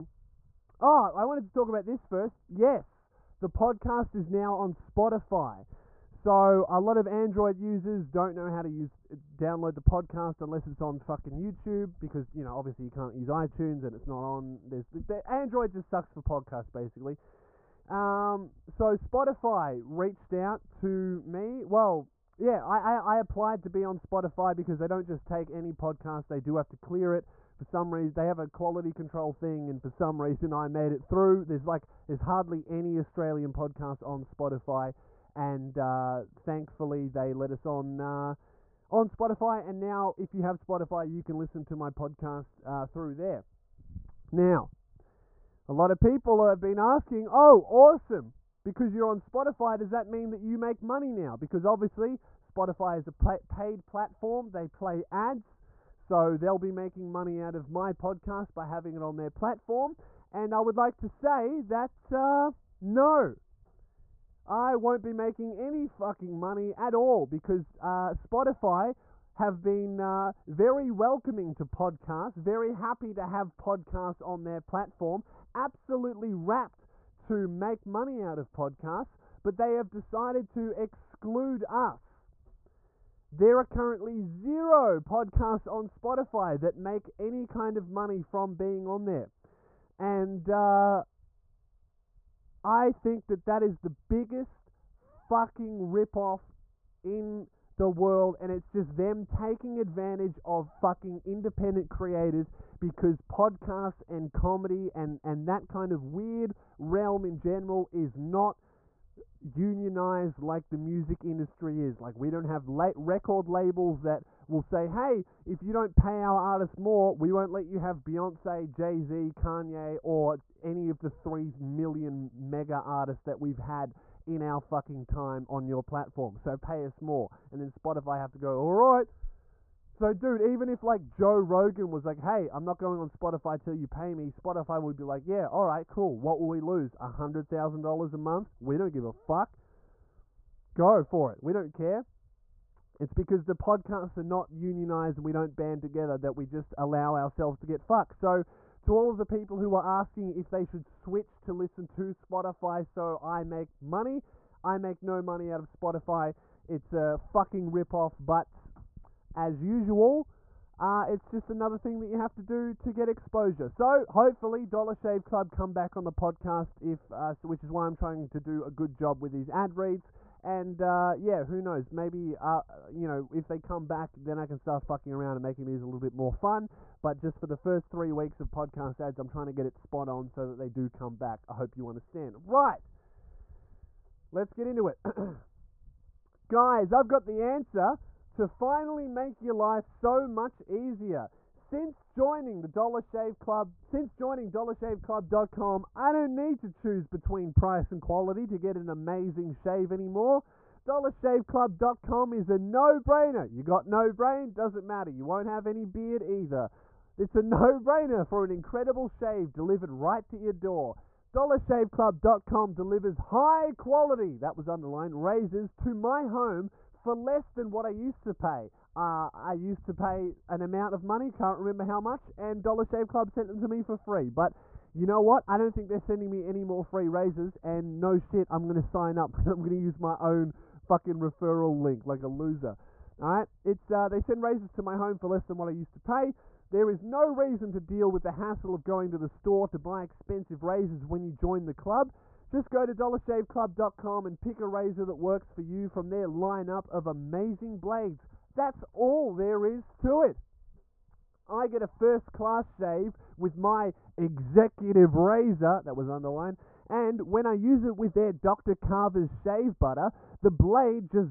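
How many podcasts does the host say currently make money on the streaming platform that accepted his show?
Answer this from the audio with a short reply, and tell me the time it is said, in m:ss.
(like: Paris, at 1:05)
0, at 1:24.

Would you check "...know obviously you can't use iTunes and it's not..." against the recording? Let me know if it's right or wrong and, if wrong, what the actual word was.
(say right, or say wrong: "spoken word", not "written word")
right.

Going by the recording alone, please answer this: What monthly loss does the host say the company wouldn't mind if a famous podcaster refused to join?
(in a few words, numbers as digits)
$100,000.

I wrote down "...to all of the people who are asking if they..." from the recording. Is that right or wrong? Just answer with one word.
right.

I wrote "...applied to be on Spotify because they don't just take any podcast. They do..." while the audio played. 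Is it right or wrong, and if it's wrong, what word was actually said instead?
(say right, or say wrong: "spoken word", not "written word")
right.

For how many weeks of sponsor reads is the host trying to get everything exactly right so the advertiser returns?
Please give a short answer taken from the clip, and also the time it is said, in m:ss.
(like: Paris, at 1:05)
3, at 2:57.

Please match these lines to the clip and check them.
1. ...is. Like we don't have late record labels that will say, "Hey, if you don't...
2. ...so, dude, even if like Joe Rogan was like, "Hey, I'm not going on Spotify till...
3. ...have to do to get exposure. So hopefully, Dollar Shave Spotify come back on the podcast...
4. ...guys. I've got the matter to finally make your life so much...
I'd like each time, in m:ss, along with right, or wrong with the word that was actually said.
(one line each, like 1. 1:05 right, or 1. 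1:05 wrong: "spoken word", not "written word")
1. 1:51 right
2. 2:09 right
3. 2:42 wrong: "Club", not "Spotify"
4. 3:06 wrong: "answer", not "matter".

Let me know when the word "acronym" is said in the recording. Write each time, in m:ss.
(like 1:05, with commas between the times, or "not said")
not said.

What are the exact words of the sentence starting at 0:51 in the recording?
Because obviously, Spotify is a paid platform, they play ads.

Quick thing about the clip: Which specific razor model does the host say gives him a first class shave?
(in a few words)
executive razor.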